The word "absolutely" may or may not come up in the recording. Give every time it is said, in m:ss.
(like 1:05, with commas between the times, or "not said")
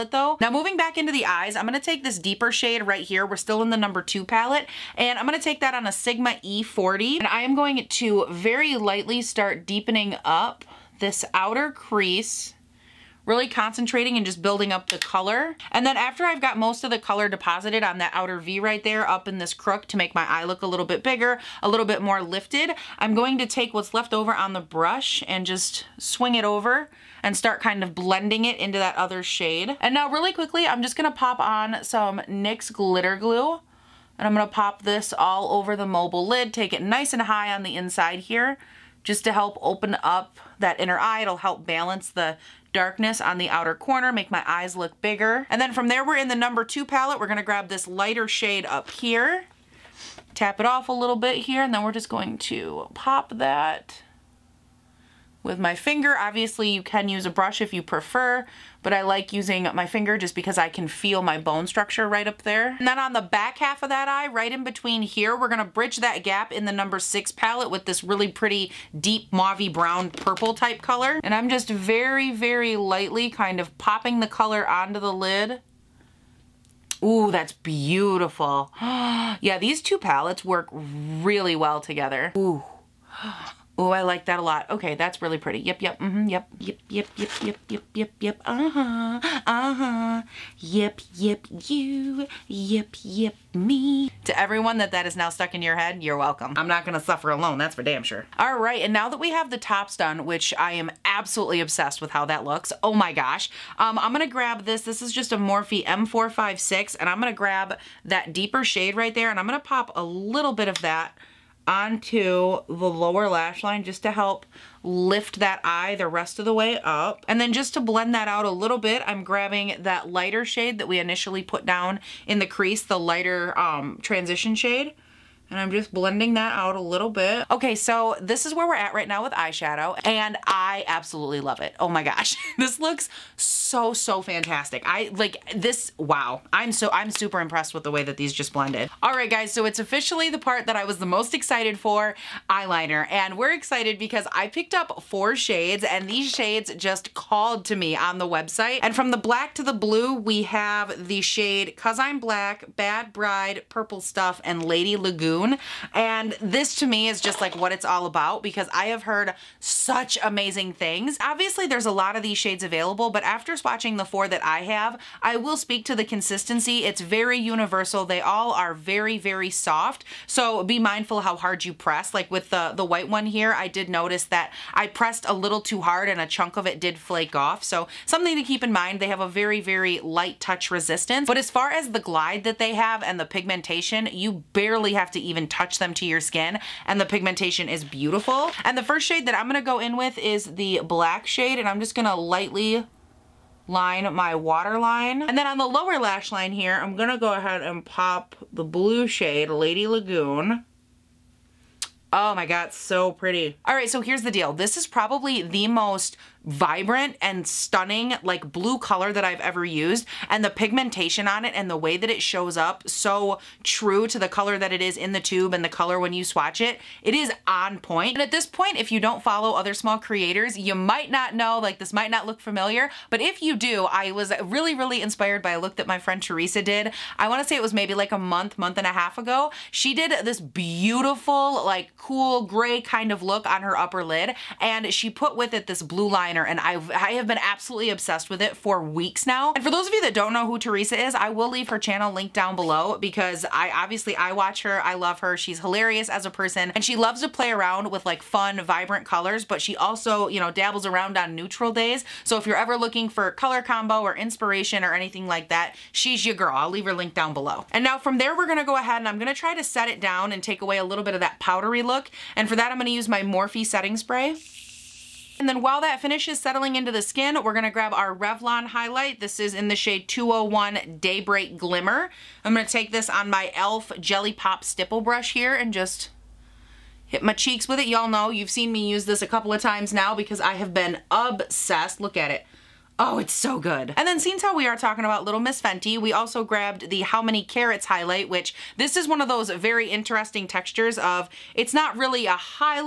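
1:41, 2:10, 3:57.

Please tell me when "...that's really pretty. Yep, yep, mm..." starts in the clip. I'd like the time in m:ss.
1:24.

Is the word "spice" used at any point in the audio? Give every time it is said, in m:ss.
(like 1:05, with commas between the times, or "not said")
not said.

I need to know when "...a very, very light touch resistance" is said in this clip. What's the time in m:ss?
2:59.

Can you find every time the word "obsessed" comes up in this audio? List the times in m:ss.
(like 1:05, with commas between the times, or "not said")
1:41, 3:57, 4:41.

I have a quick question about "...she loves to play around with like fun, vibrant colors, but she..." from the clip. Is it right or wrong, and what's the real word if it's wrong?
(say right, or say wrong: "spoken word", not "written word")
right.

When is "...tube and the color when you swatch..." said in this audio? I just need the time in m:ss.
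3:35.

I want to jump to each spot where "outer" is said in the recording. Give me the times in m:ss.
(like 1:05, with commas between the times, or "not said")
0:11, 0:18, 0:43.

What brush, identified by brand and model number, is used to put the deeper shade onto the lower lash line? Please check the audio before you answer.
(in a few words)
Morphe M456.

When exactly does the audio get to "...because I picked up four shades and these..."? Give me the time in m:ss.
2:23.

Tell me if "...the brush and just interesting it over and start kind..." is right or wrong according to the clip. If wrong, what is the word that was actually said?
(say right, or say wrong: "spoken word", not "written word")
wrong: "swing", not "interesting".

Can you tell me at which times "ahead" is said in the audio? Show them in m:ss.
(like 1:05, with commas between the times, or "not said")
3:17, 4:18.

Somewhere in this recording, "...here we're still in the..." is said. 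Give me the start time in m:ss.
0:03.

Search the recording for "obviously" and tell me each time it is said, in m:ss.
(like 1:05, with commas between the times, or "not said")
0:56, 2:41, 4:03.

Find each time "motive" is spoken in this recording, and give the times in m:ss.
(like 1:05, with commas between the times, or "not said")
not said.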